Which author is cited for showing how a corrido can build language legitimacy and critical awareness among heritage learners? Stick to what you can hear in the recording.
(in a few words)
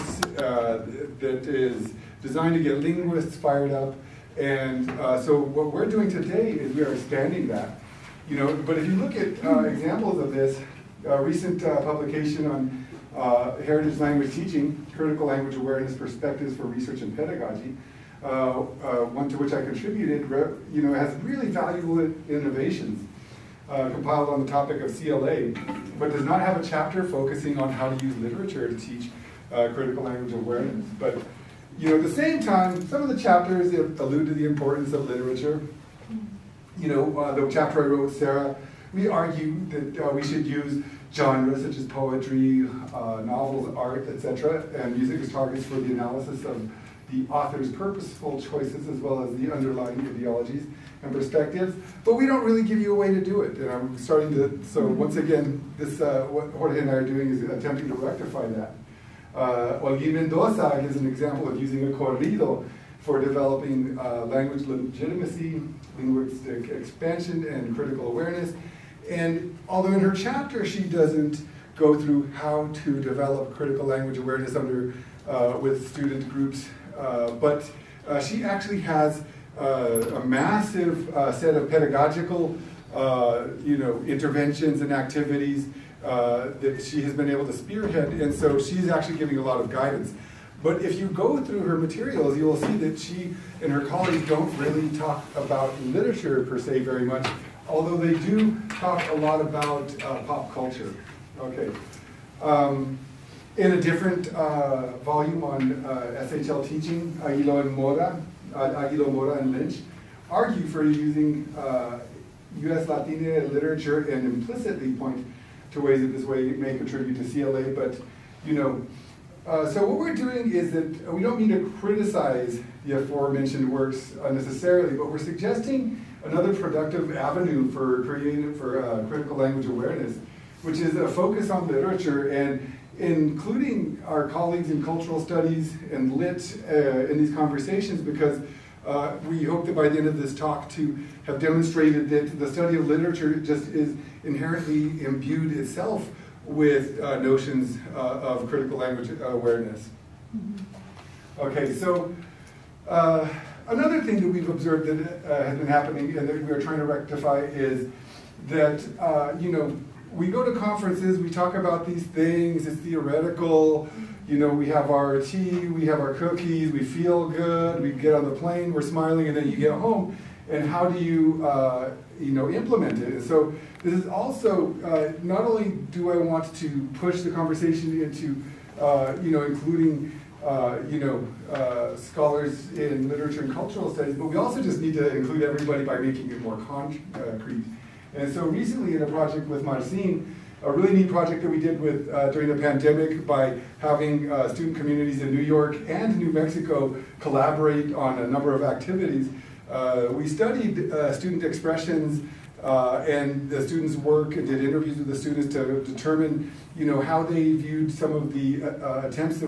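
Olguín Mendoza.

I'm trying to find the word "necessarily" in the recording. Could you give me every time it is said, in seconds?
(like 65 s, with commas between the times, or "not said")
124 s.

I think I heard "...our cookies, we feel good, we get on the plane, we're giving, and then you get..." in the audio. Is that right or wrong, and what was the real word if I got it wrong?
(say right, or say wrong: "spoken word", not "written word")
wrong: "smiling", not "giving".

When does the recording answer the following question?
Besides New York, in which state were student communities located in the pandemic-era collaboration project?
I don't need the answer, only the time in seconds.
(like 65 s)
196 s.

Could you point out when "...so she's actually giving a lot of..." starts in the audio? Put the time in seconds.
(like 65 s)
88 s.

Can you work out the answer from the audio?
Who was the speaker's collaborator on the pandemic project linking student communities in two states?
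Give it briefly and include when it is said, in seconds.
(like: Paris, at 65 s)
Marcin, at 189 s.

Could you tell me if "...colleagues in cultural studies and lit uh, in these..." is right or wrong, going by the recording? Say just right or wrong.
right.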